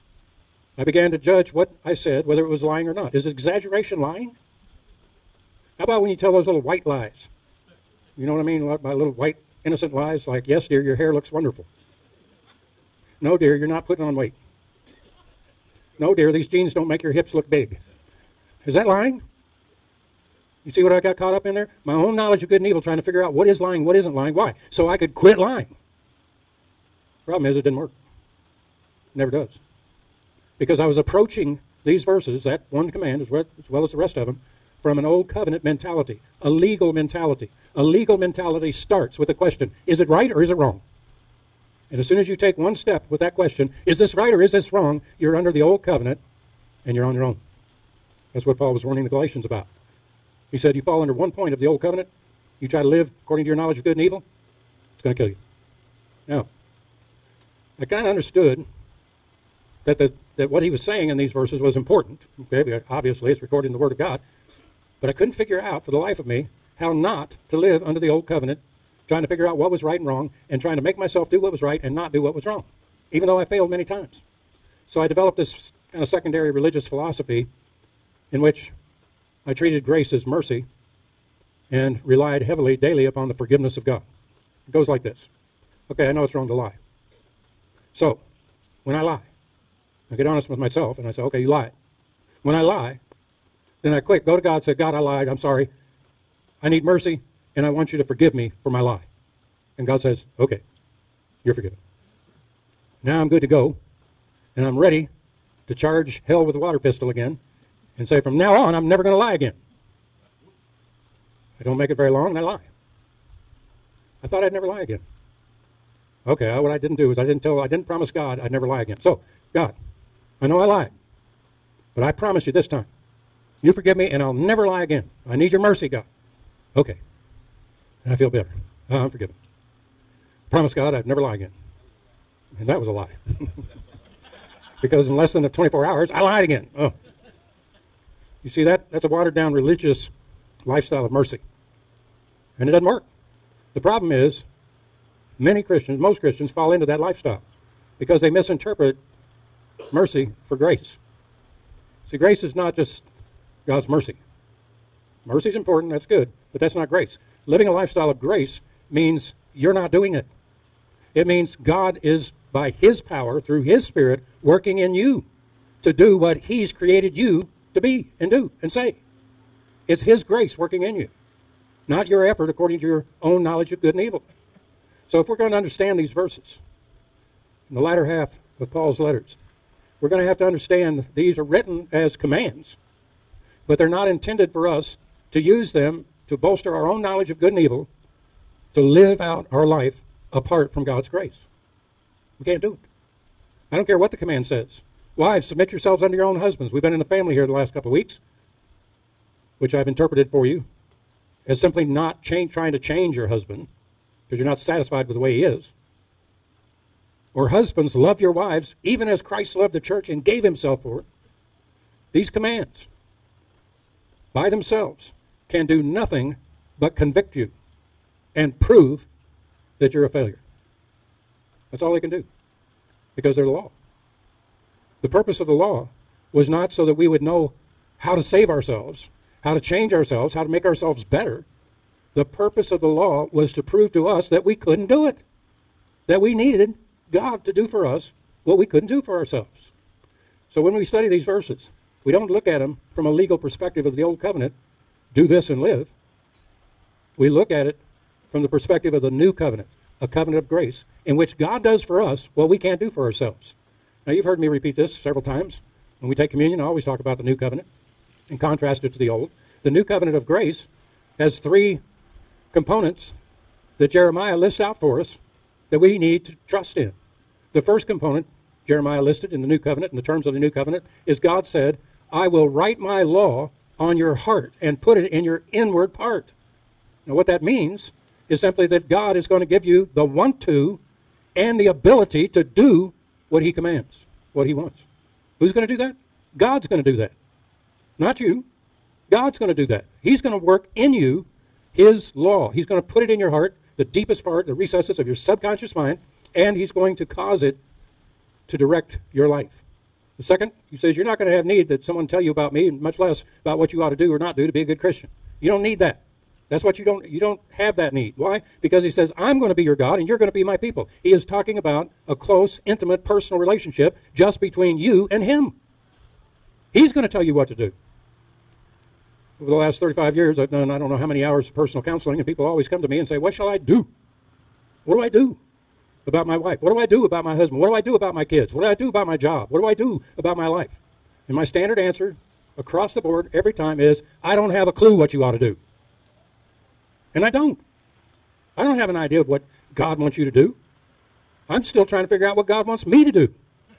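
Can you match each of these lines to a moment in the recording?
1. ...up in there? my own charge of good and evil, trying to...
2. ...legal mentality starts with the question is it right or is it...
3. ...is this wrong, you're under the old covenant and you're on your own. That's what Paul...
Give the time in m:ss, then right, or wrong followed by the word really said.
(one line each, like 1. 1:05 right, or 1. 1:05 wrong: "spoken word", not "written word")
1. 0:21 wrong: "knowledge", not "charge"
2. 0:37 right
3. 0:44 right.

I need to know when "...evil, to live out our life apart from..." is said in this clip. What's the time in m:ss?
3:07.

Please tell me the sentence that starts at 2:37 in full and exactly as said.
Living a lifestyle of grace means you're not doing it.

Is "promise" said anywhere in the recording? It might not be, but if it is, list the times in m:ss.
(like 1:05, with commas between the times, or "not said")
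1:57, 2:02, 2:10.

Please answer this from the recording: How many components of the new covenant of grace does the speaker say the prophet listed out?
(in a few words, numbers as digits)
3.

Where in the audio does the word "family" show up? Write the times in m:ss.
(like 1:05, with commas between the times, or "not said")
3:17.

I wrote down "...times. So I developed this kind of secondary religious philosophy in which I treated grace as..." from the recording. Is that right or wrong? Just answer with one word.
right.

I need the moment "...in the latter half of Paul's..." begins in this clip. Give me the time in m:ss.
2:57.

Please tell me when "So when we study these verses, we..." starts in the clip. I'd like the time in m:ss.
4:00.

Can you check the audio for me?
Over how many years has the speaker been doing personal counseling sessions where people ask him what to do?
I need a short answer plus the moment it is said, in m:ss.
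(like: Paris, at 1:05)
35, at 5:19.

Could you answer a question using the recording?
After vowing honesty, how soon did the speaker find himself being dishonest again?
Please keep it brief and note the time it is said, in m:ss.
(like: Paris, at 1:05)
less than 24 hours, at 2:15.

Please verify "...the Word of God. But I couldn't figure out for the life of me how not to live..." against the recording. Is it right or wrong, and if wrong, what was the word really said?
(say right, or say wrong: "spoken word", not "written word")
right.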